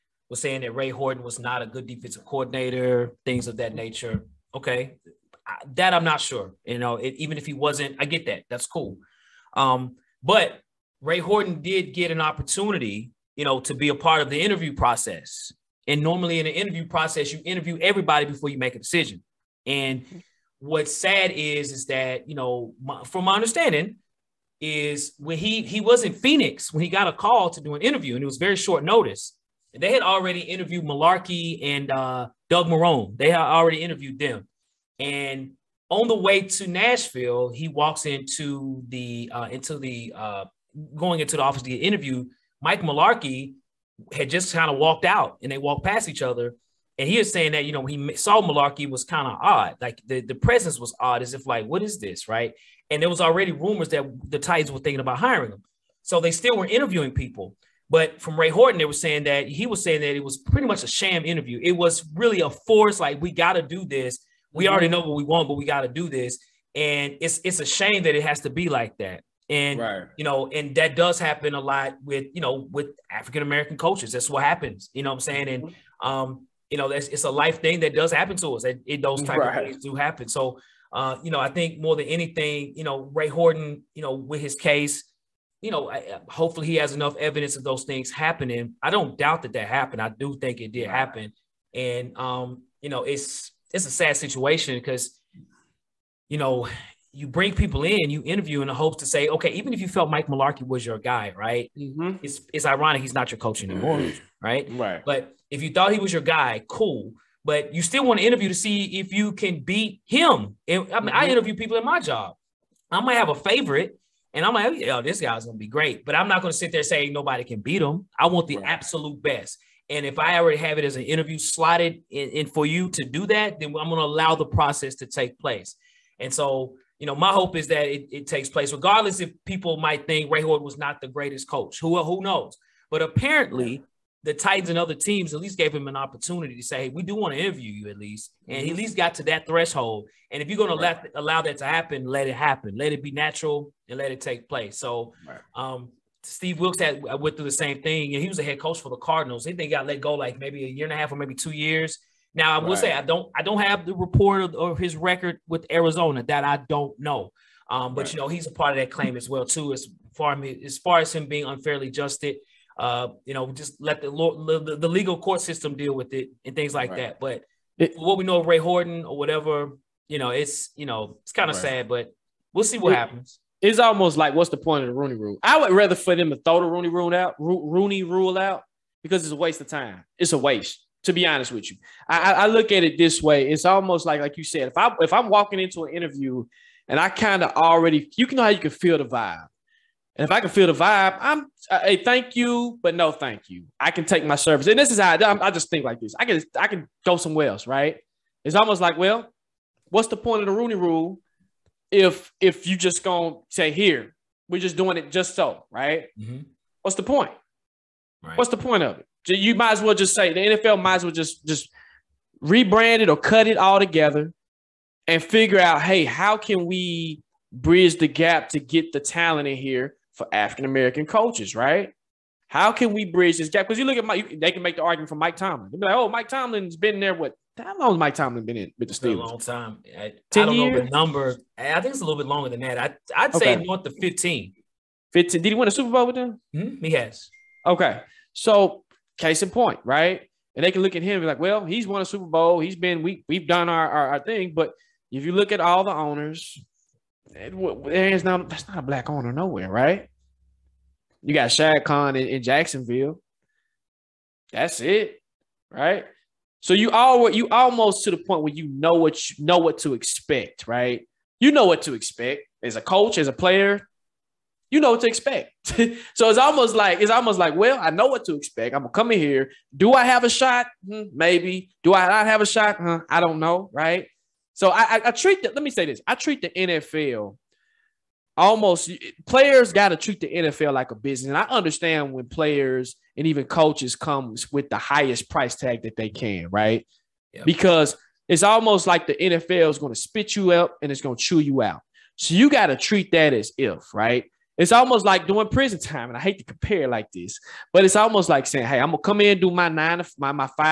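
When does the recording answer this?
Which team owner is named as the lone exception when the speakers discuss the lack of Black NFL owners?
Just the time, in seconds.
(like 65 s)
251 s.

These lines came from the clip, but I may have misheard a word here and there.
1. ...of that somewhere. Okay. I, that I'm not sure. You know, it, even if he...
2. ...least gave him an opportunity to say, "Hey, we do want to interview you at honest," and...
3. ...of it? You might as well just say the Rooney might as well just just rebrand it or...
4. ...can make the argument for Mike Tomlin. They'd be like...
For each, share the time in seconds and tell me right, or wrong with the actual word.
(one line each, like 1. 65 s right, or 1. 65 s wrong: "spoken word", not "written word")
1. 3 s wrong: "nature", not "somewhere"
2. 135 s wrong: "least", not "honest"
3. 208 s wrong: "NFL", not "Rooney"
4. 224 s right.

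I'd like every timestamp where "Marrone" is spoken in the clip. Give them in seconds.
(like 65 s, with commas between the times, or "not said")
32 s.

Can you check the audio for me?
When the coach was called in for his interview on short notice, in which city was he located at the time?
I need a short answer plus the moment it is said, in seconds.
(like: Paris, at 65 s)
Phoenix, at 26 s.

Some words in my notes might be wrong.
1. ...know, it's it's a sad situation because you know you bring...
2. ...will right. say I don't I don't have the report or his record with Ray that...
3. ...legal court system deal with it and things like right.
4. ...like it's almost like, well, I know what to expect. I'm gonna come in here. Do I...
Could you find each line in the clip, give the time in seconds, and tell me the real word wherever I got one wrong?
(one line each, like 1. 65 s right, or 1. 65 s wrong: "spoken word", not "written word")
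1. 92 s right
2. 152 s wrong: "Arizona", not "Ray"
3. 164 s right
4. 266 s right.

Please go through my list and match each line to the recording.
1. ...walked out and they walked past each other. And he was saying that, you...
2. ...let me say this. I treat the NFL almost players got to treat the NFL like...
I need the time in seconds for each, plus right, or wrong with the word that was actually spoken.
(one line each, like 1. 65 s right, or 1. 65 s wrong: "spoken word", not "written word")
1. 44 s right
2. 275 s right.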